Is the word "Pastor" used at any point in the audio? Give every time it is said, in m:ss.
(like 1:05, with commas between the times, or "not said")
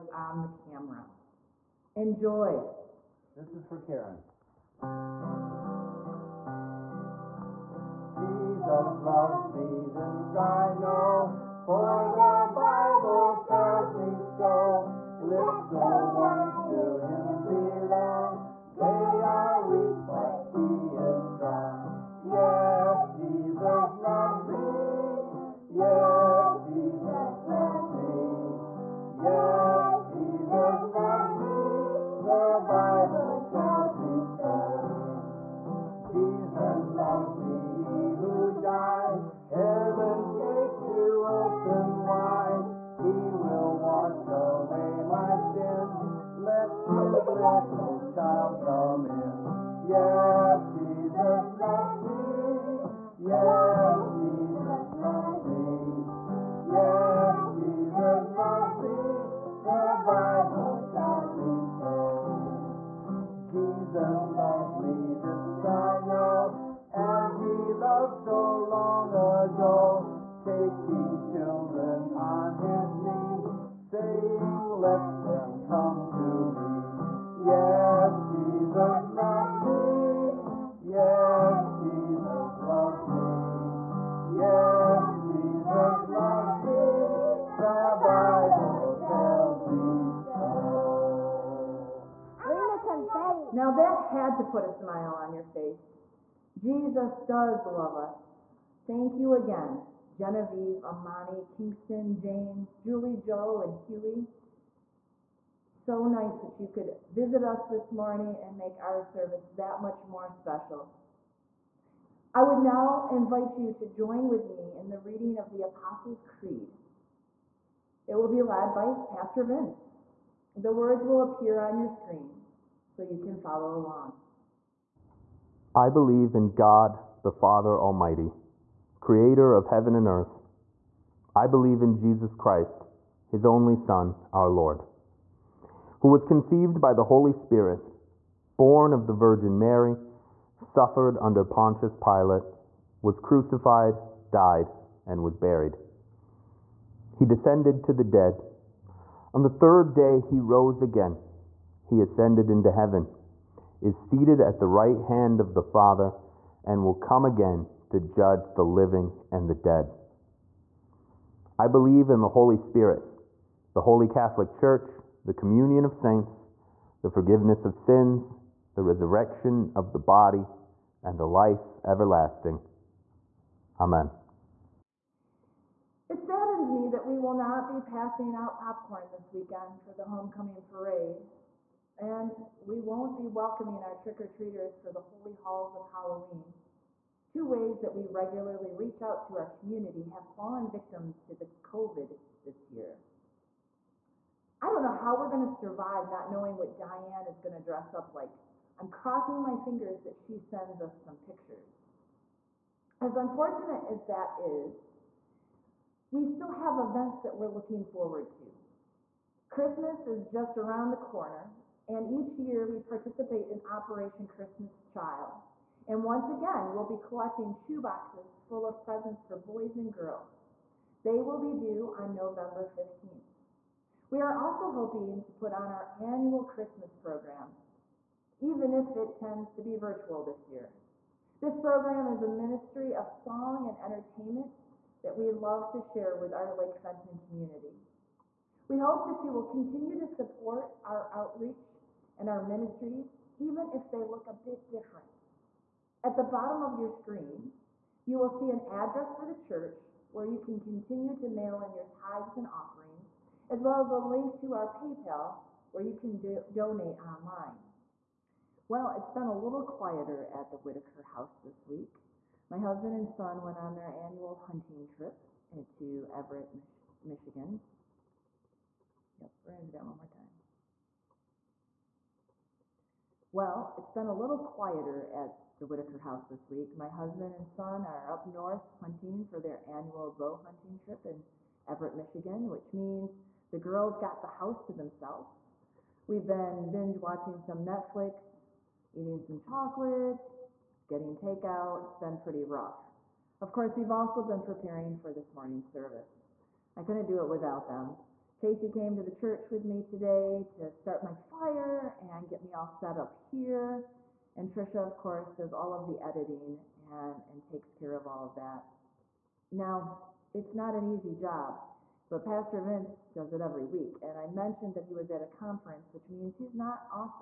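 1:59, 5:12.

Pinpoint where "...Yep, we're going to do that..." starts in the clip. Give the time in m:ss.
4:29.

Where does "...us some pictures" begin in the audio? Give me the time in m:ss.
3:20.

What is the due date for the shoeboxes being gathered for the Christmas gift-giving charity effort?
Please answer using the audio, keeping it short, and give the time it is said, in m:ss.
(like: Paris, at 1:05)
November 15th, at 3:41.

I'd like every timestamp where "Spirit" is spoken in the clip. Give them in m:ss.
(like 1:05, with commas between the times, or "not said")
2:17, 2:42.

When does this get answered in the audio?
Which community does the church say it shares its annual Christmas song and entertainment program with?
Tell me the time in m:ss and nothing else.
3:56.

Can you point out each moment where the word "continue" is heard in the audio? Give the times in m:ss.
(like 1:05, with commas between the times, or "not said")
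3:59, 4:10.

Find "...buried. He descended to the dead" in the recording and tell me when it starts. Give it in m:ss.
2:25.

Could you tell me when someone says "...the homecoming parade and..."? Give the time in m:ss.
2:59.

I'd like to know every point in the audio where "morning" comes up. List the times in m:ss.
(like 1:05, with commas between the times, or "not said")
1:47, 4:55.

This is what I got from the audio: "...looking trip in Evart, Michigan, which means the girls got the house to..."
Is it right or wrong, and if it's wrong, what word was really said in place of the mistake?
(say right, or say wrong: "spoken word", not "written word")
wrong: "hunting", not "looking".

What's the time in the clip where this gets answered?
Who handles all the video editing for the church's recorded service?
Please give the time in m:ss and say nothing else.
5:04.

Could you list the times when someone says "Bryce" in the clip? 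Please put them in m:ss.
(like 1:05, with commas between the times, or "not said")
not said.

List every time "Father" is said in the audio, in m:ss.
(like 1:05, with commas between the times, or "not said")
2:07, 2:35.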